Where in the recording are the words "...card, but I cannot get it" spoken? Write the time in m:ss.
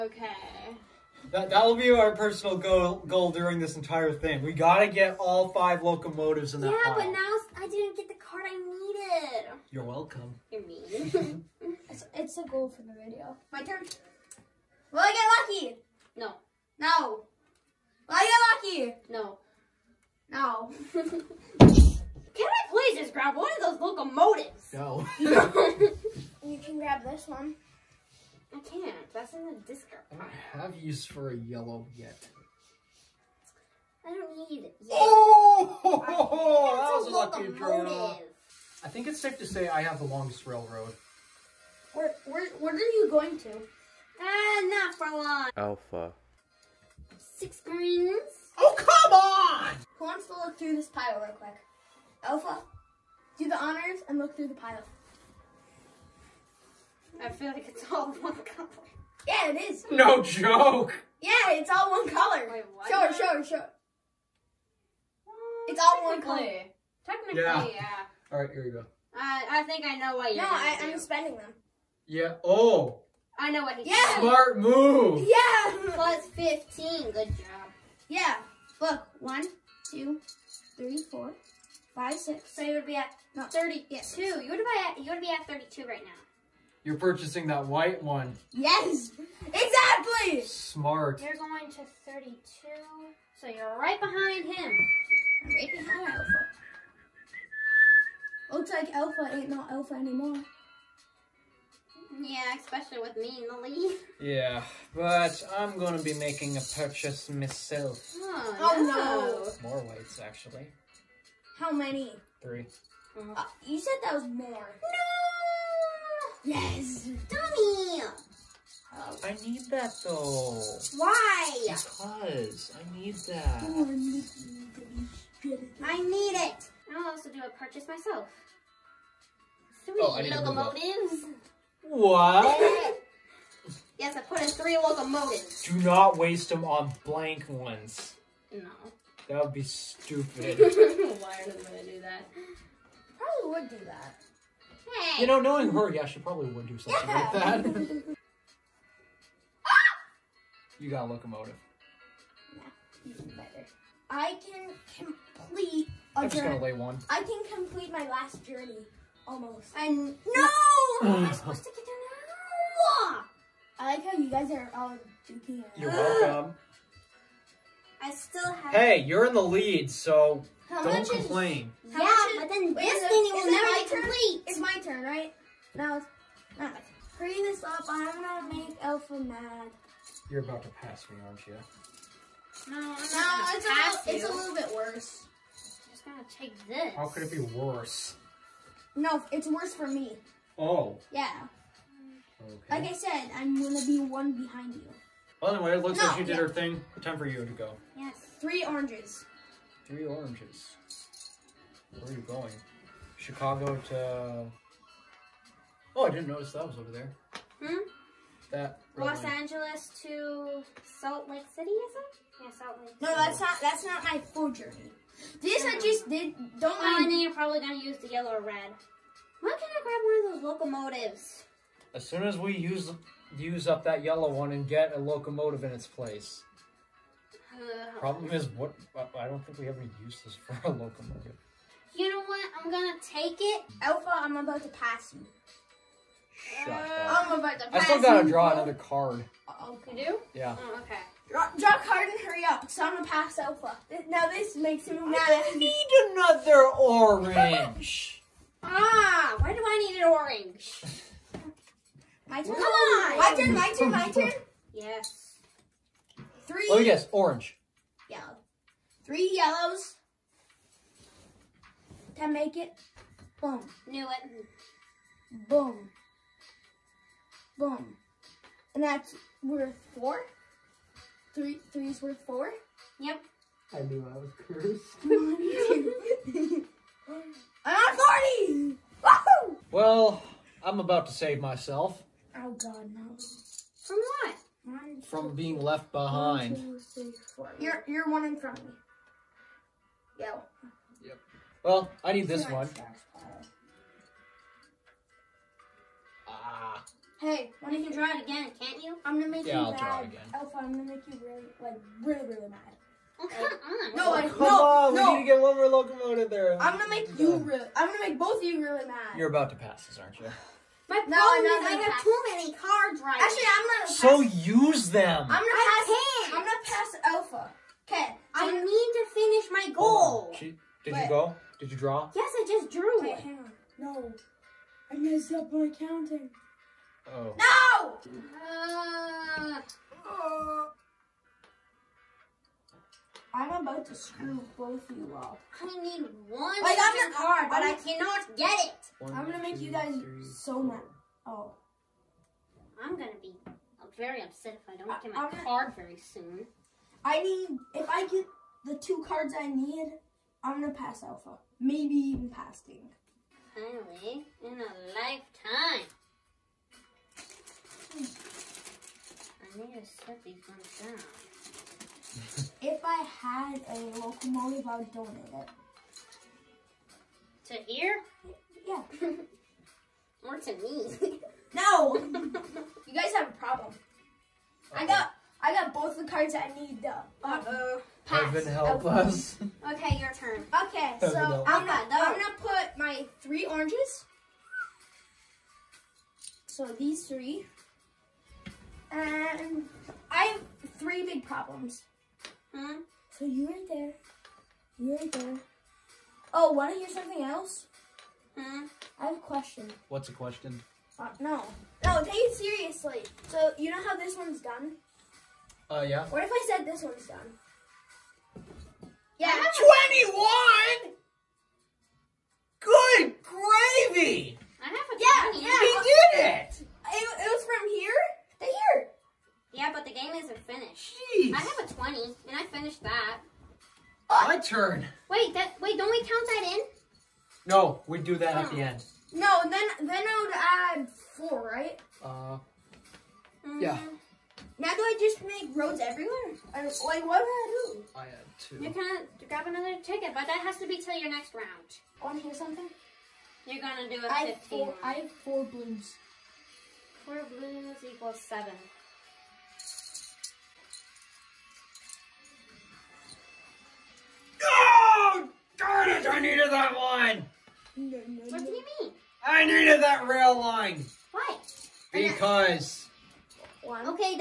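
5:37.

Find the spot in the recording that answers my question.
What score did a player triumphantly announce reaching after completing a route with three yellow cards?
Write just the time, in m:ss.
4:37.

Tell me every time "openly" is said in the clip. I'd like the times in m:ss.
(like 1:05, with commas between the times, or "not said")
not said.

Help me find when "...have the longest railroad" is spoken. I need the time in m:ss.
0:39.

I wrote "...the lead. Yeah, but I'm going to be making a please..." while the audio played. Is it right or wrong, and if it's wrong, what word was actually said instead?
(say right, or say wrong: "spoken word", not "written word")
wrong: "purchase", not "please".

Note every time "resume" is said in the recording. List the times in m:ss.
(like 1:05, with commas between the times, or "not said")
not said.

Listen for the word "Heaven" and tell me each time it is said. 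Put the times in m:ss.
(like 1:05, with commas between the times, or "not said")
6:18.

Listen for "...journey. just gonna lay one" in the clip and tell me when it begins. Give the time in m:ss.
2:36.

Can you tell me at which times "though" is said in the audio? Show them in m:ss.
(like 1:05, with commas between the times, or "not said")
2:00, 6:16.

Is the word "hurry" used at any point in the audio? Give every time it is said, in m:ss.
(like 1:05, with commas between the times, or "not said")
2:57, 4:02.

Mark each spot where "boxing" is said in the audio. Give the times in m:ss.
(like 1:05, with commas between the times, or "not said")
not said.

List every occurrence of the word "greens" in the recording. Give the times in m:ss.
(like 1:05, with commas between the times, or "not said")
0:47.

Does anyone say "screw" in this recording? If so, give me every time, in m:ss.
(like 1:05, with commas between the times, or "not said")
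5:33.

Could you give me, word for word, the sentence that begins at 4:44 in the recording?
One, From two, being left behind.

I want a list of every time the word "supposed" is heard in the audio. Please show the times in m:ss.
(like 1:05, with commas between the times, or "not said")
2:41.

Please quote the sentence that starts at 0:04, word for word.
We gotta get all five locomotives in that.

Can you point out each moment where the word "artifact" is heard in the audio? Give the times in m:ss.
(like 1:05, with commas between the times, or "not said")
not said.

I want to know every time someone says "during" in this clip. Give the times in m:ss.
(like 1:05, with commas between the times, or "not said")
0:03.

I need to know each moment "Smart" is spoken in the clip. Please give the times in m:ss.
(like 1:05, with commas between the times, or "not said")
1:14, 1:30.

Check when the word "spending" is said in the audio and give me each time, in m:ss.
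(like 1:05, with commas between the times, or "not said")
1:10.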